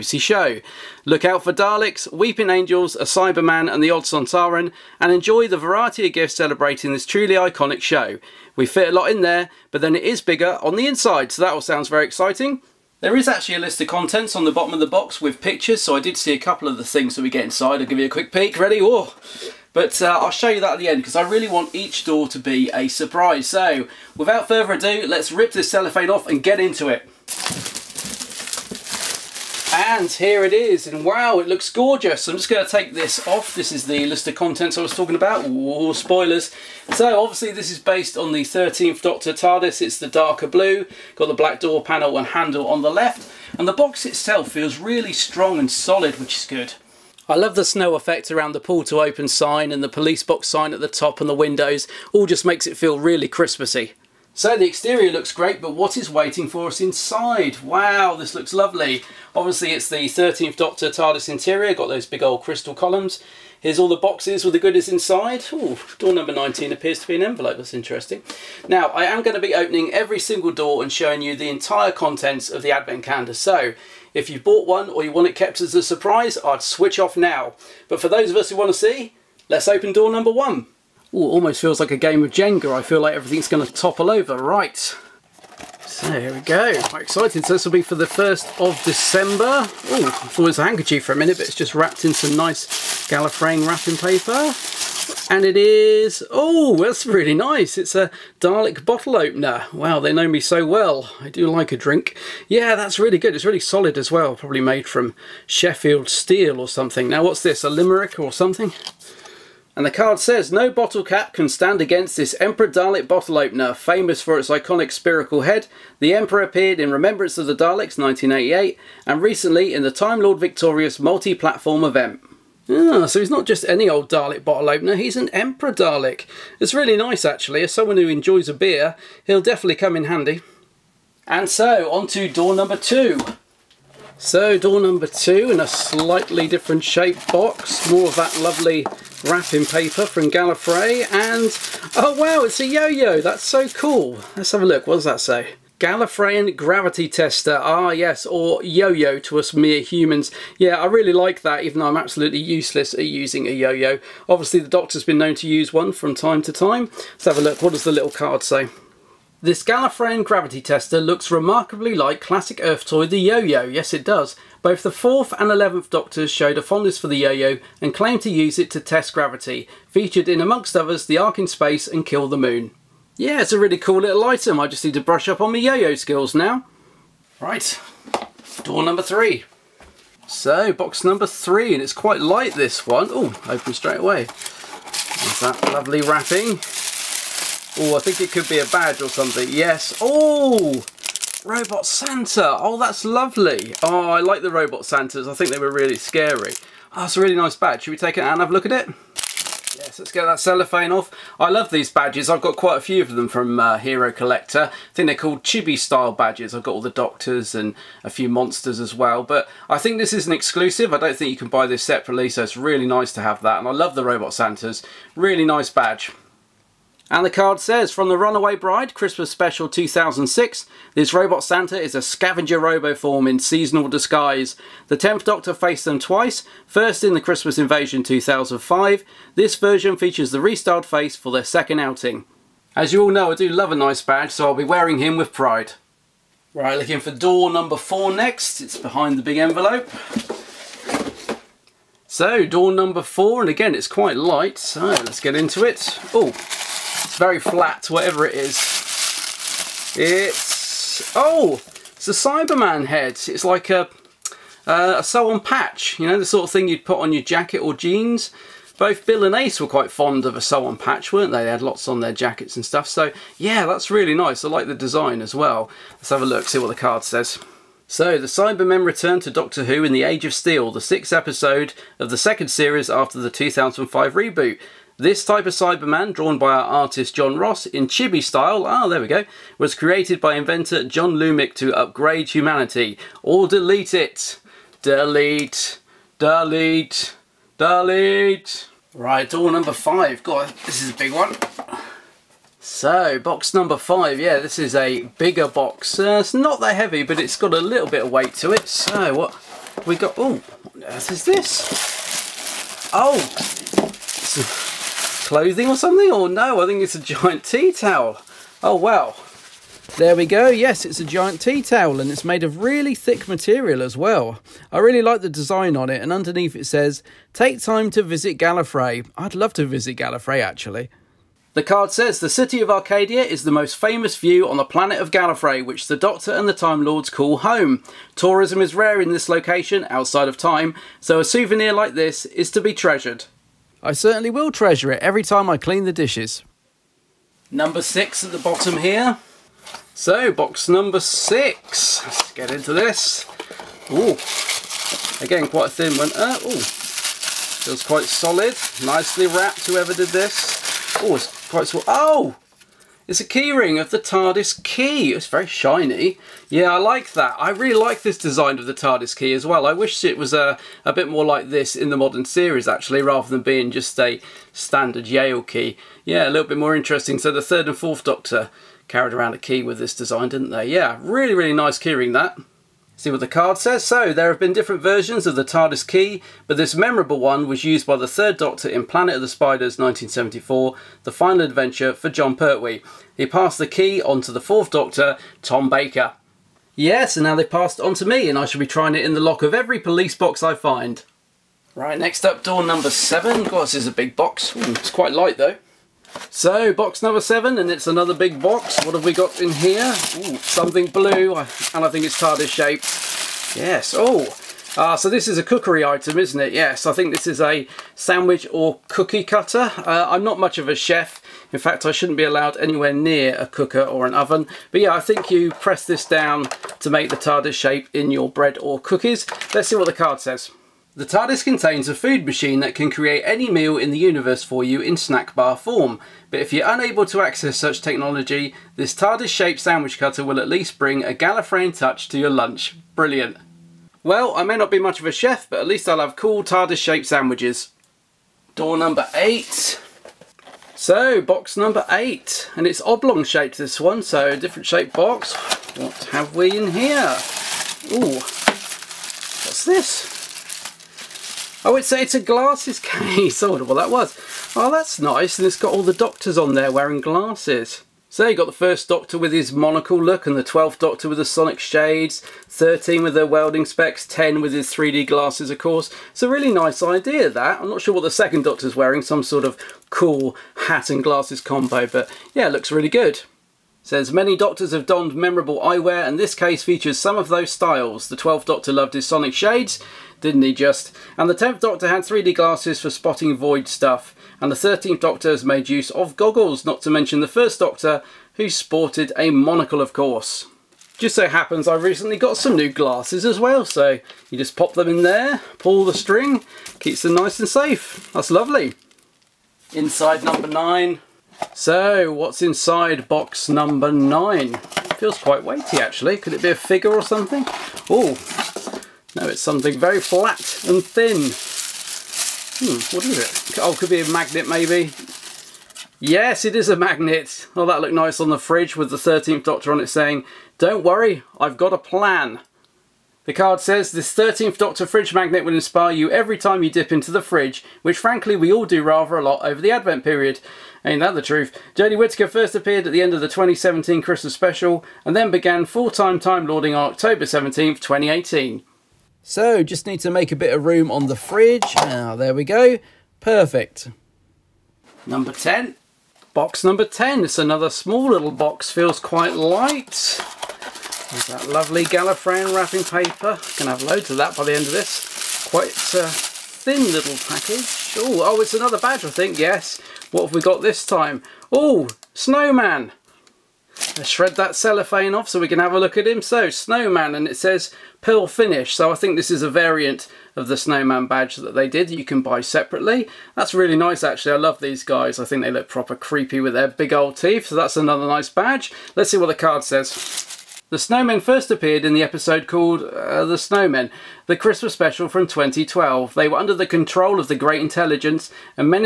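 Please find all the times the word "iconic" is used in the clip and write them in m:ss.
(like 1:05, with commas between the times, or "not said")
0:07, 1:54.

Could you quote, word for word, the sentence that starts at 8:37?
Oh, that looked nice on the fridge with the 13th Doctor on it saying, Don't worry, I've got a plan.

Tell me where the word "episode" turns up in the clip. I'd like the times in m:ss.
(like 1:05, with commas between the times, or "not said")
4:31, 9:42.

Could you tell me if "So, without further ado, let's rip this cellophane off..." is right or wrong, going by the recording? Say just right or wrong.
right.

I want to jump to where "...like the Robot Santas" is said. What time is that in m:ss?
3:14.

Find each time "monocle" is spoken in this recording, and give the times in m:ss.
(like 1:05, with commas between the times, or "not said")
7:39, 8:09.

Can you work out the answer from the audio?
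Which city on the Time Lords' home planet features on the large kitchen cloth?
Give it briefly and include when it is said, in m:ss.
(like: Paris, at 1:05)
Arcadia, at 5:22.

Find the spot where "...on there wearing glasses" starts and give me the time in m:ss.
7:36.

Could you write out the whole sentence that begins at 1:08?
Now, I am going to be opening every single door and showing you the entire contents of the advent calendar.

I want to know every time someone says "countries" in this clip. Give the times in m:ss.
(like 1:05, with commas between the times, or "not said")
not said.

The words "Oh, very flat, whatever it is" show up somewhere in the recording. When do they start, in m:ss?
4:06.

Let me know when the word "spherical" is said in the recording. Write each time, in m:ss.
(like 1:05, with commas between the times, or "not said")
1:54.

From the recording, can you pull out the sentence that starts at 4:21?
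They had lots on their jackets and stuff.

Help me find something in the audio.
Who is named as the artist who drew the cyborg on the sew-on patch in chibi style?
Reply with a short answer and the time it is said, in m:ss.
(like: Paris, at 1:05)
John Ross, at 4:37.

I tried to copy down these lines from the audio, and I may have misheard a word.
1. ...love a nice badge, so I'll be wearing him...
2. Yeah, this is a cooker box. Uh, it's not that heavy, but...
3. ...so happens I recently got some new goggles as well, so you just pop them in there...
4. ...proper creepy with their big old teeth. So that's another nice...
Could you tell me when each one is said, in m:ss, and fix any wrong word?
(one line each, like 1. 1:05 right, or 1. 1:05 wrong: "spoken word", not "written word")
1. 3:53 right
2. 4:54 wrong: "bigger", not "cooker"
3. 8:11 wrong: "glasses", not "goggles"
4. 9:35 right.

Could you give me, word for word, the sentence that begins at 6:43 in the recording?
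Yes, oh, uh, so this is a cookery item, isn't it?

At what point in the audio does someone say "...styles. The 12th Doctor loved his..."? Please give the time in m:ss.
7:57.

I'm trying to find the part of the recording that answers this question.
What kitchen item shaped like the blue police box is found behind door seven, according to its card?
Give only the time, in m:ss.
7:09.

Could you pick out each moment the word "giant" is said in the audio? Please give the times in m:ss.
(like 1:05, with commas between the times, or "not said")
5:06, 5:11.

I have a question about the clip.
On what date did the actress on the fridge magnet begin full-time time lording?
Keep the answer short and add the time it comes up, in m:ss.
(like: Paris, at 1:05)
October 17th, 2018, at 8:56.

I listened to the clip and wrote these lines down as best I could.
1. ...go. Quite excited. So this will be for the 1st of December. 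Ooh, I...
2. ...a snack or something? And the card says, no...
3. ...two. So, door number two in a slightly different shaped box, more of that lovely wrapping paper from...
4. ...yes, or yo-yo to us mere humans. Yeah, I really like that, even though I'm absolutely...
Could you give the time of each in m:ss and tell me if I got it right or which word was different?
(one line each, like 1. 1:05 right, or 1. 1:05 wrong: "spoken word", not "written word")
1. 1:26 right
2. 1:47 wrong: "limerick", not "snack"
3. 2:12 right
4. 2:27 right.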